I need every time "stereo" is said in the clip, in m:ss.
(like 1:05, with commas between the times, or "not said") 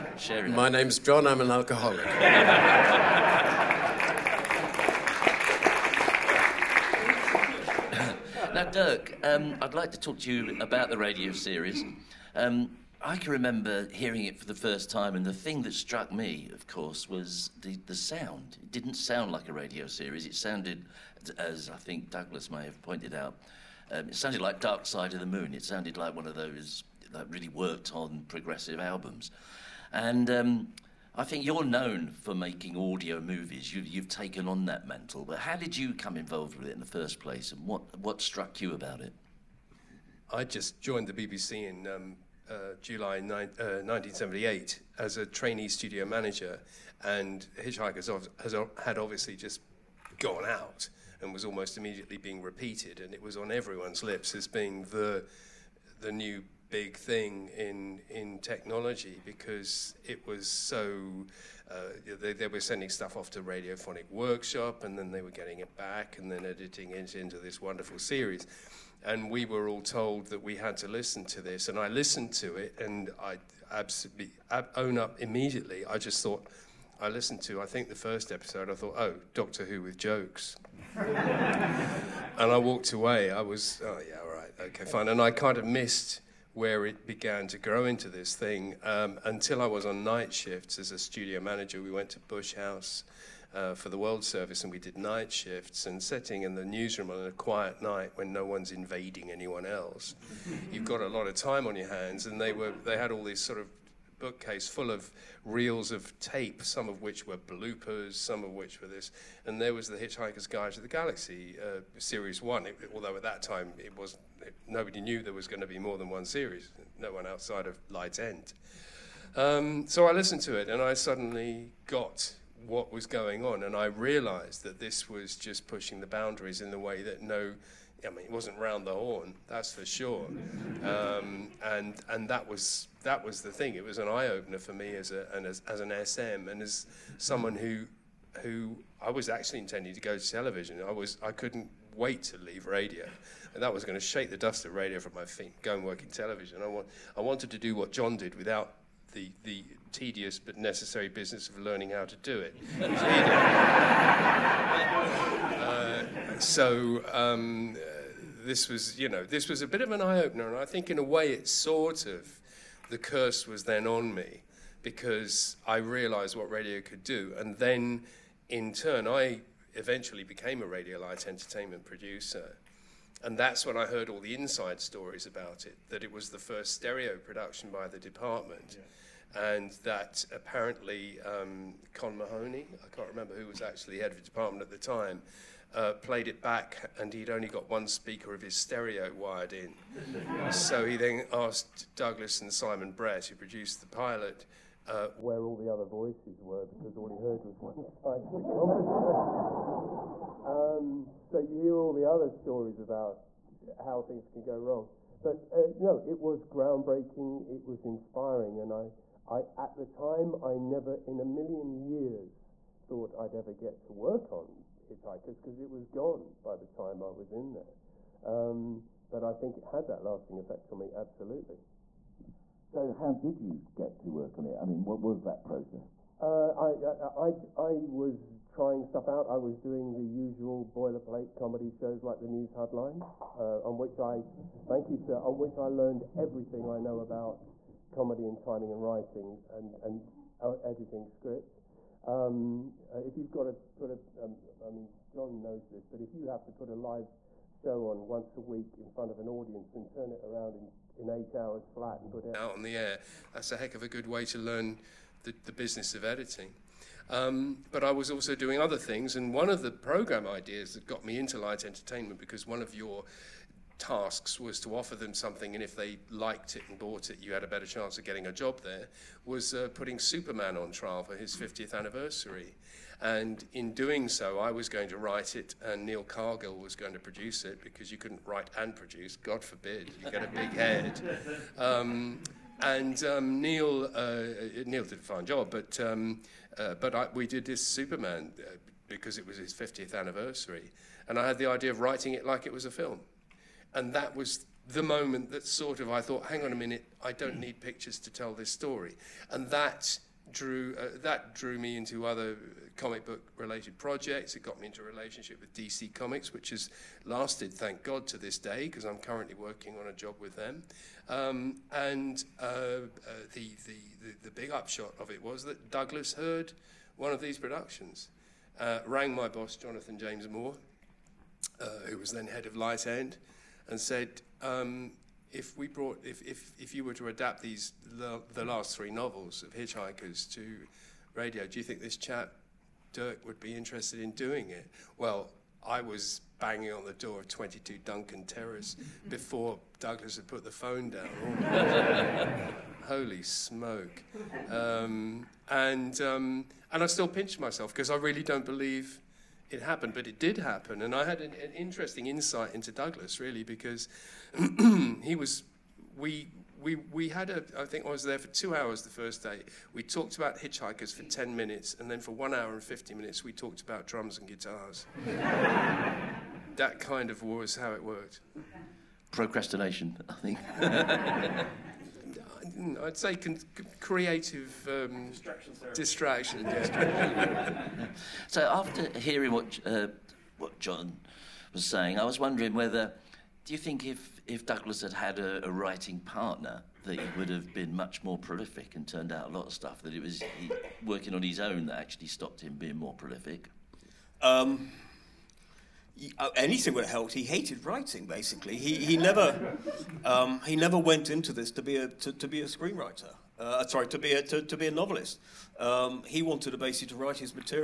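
2:56, 3:08.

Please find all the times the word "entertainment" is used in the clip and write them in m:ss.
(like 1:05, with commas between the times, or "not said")
2:51, 4:21.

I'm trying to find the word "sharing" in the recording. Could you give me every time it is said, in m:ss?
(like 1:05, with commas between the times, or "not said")
0:00.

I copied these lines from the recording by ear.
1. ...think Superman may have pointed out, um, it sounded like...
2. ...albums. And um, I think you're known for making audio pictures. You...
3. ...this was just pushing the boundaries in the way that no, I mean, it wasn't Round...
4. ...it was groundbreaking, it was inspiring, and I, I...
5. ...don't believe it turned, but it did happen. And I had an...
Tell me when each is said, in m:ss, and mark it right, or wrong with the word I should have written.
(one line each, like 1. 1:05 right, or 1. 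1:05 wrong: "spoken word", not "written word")
1. 0:21 wrong: "Douglas", not "Superman"
2. 0:28 wrong: "movies", not "pictures"
3. 2:04 right
4. 3:26 right
5. 5:48 wrong: "happened", not "turned".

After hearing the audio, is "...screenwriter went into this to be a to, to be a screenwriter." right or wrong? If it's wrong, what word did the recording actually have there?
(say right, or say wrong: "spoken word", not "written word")
wrong: "never", not "screenwriter".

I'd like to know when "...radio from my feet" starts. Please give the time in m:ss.
2:24.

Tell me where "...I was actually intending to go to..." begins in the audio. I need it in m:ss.
2:18.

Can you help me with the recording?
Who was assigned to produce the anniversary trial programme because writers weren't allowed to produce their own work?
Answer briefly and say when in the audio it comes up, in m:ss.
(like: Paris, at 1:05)
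Neil Cargill, at 4:35.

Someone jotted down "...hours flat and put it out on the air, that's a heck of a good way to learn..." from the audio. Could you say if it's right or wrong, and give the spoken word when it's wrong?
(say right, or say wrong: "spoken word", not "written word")
right.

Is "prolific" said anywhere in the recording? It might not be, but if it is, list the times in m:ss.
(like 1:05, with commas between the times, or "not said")
6:28, 6:32.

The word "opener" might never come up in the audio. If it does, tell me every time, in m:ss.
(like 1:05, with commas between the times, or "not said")
2:14, 2:40.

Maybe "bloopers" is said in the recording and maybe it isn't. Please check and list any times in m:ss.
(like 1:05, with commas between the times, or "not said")
1:47.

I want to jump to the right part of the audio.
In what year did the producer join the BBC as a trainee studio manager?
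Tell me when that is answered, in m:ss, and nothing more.
0:43.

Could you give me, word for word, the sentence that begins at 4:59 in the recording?
And that drew, uh, that drew me into other comic book related projects.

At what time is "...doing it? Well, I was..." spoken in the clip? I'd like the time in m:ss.
5:34.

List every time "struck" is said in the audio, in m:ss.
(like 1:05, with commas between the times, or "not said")
0:15, 0:38.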